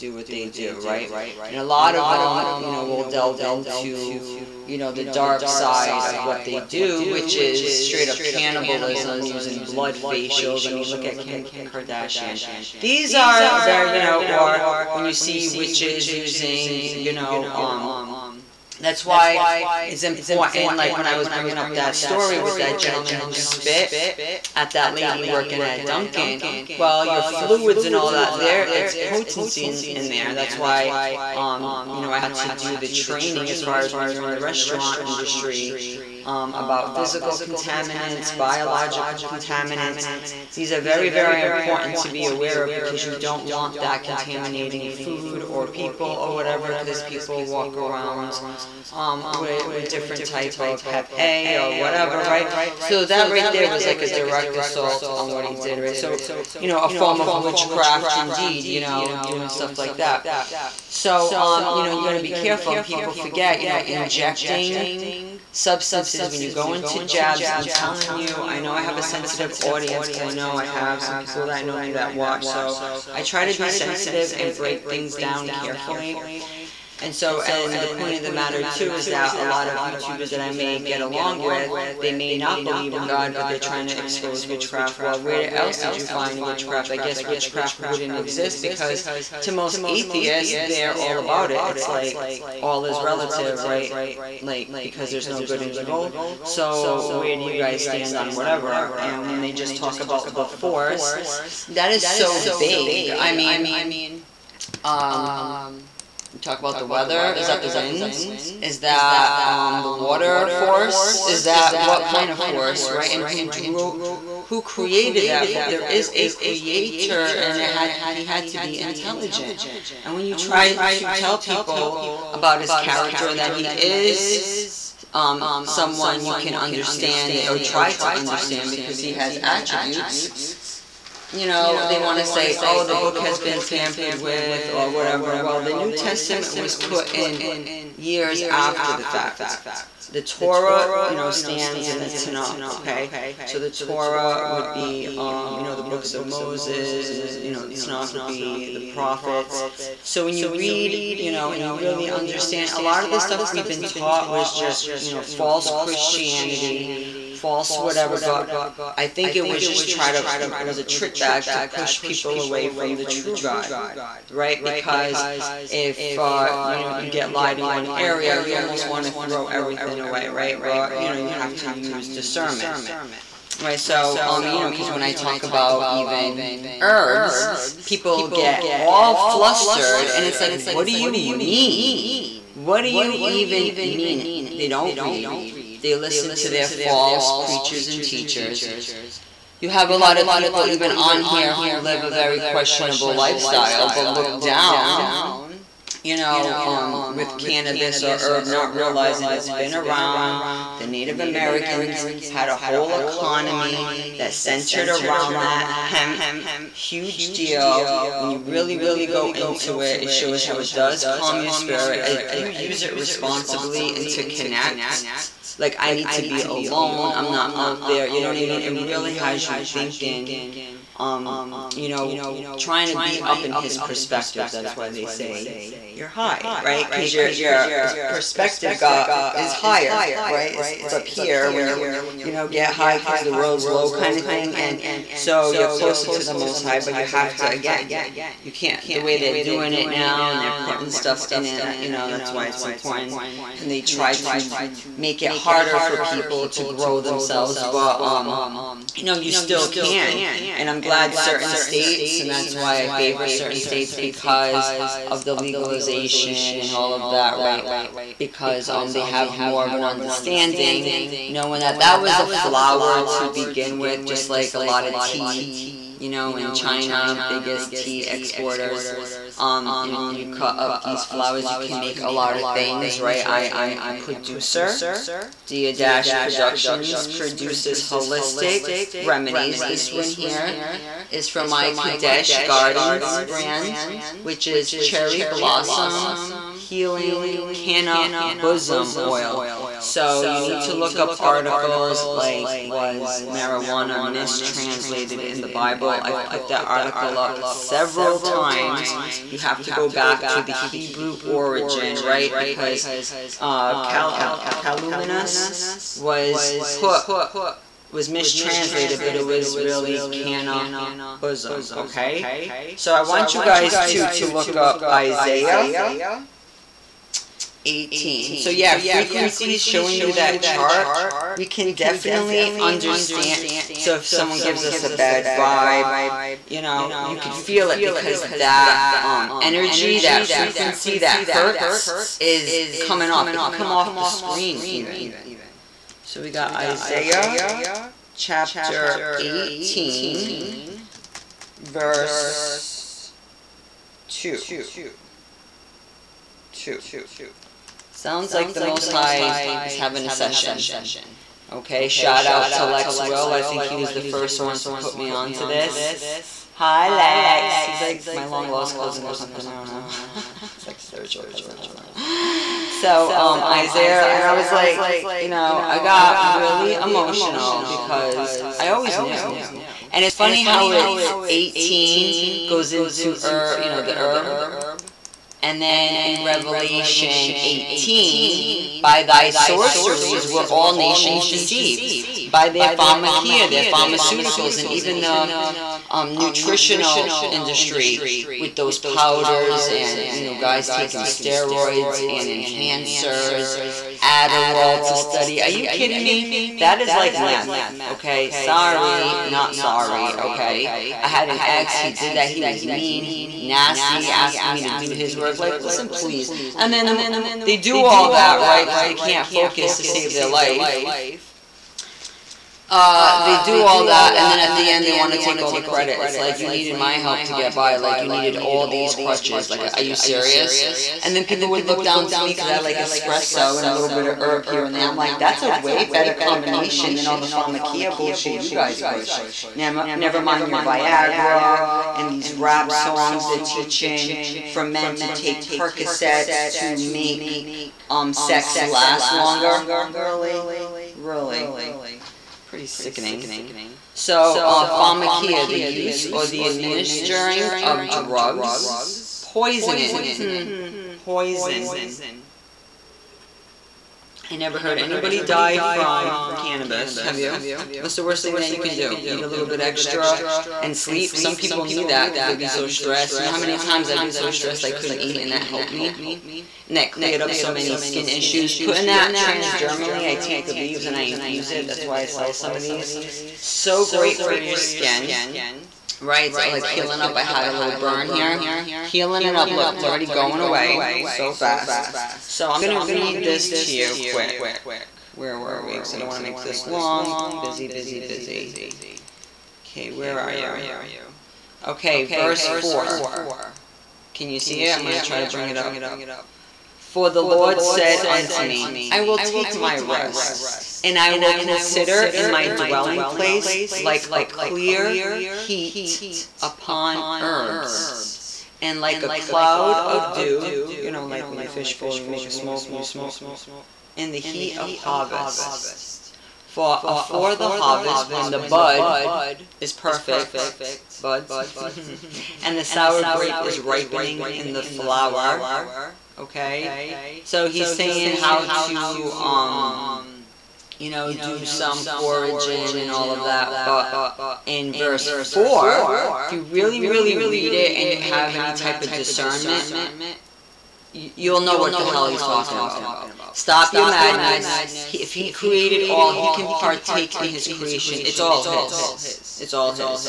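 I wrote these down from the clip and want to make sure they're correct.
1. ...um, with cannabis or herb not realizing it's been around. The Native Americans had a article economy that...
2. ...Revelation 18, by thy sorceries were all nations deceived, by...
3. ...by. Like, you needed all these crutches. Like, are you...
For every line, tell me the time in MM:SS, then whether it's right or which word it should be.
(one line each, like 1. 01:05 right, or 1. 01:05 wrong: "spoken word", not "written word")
1. 03:16 wrong: "whole", not "article"
2. 06:16 right
3. 06:57 right.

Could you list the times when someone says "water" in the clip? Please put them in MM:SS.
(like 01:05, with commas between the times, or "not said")
01:49.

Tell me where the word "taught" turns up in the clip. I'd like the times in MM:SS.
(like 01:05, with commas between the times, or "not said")
02:33.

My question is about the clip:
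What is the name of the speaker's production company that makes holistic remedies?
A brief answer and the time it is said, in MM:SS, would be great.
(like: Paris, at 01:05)
Dia Dash Productions, at 04:35.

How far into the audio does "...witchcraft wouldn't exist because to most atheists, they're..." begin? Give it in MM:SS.
01:27.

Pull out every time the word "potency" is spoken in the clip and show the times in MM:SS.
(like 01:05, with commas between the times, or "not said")
00:28.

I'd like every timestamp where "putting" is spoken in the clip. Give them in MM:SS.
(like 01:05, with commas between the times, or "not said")
04:00, 07:48.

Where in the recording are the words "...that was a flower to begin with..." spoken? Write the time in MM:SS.
04:21.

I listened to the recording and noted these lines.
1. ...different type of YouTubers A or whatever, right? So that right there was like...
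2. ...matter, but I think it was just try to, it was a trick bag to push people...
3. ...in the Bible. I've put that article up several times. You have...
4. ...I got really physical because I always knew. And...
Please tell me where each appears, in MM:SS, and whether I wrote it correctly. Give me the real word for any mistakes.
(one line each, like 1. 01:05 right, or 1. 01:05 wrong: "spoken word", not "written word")
1. 00:49 wrong: "Hep", not "YouTubers"
2. 02:37 wrong: "whatever", not "matter"
3. 04:55 right
4. 06:05 wrong: "emotional", not "physical".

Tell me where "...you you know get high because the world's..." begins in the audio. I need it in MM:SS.
03:51.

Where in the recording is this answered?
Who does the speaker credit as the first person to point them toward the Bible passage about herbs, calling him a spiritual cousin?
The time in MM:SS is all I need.
05:52.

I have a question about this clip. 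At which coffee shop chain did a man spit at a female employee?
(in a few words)
Dunkin'.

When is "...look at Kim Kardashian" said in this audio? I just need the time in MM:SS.
00:10.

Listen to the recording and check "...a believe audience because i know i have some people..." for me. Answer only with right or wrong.
wrong.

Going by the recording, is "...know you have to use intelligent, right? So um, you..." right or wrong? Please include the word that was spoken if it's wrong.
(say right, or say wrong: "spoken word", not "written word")
wrong: "discernment", not "intelligent".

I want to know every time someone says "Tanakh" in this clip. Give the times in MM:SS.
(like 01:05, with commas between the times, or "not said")
02:22, 02:27.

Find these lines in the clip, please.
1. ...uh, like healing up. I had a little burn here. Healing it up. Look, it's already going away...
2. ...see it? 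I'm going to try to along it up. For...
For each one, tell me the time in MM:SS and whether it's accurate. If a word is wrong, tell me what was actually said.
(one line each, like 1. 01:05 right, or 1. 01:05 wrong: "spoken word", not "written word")
1. 07:56 right
2. 08:14 wrong: "bring", not "along".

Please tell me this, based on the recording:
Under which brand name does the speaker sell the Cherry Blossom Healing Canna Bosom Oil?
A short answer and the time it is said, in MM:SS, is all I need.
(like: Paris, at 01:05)
Kadesh Gardens, at 04:41.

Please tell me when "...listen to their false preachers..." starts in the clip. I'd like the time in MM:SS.
03:05.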